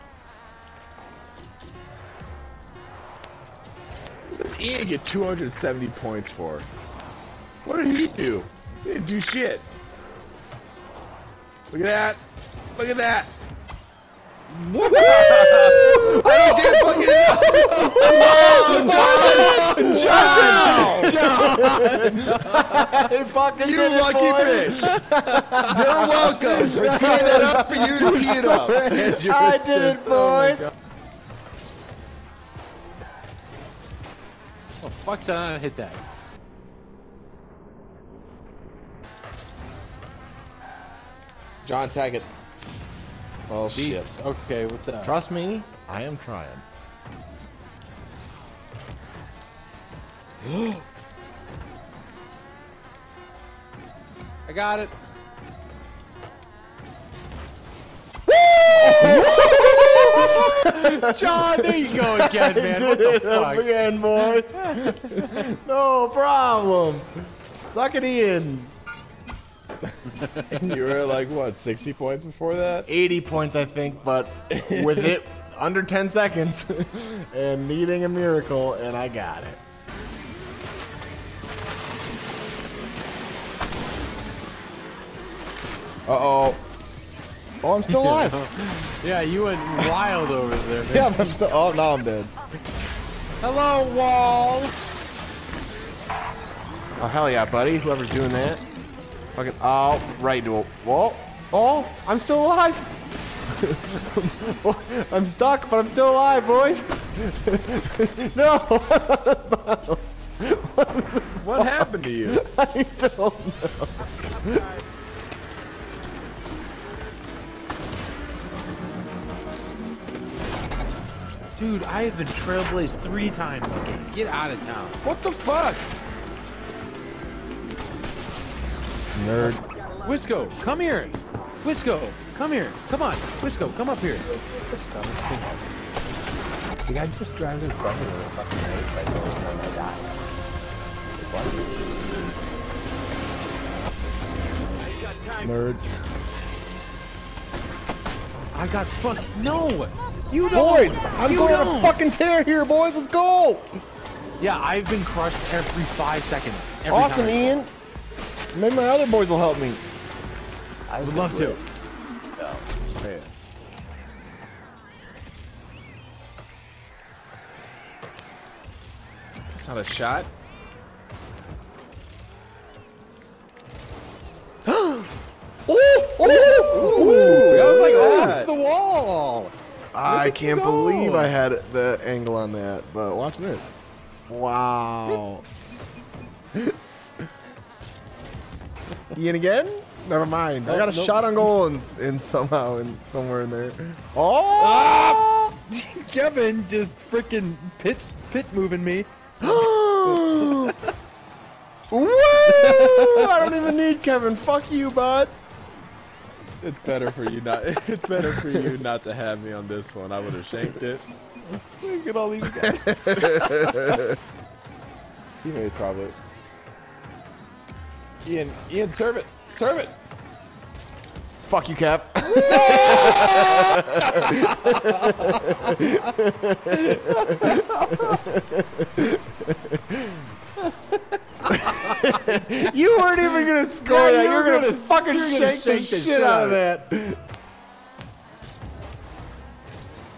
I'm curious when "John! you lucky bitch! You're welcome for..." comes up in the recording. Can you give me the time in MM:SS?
00:23.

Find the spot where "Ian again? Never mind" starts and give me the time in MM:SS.
03:09.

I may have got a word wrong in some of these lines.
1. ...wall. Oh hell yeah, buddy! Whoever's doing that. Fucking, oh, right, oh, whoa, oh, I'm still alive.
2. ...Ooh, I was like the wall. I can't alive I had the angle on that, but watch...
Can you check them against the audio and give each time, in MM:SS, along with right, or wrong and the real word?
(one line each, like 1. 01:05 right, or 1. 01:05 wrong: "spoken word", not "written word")
1. 01:33 right
2. 02:57 wrong: "believe", not "alive".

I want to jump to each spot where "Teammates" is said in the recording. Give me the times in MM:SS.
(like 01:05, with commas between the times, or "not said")
03:35.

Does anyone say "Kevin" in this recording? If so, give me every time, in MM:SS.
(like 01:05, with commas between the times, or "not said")
03:16, 03:24.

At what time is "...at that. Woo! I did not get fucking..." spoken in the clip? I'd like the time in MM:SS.
00:12.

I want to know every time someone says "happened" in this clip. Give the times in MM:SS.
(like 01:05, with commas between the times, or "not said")
01:51.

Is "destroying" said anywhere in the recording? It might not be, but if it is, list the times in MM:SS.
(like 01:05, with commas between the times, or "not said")
not said.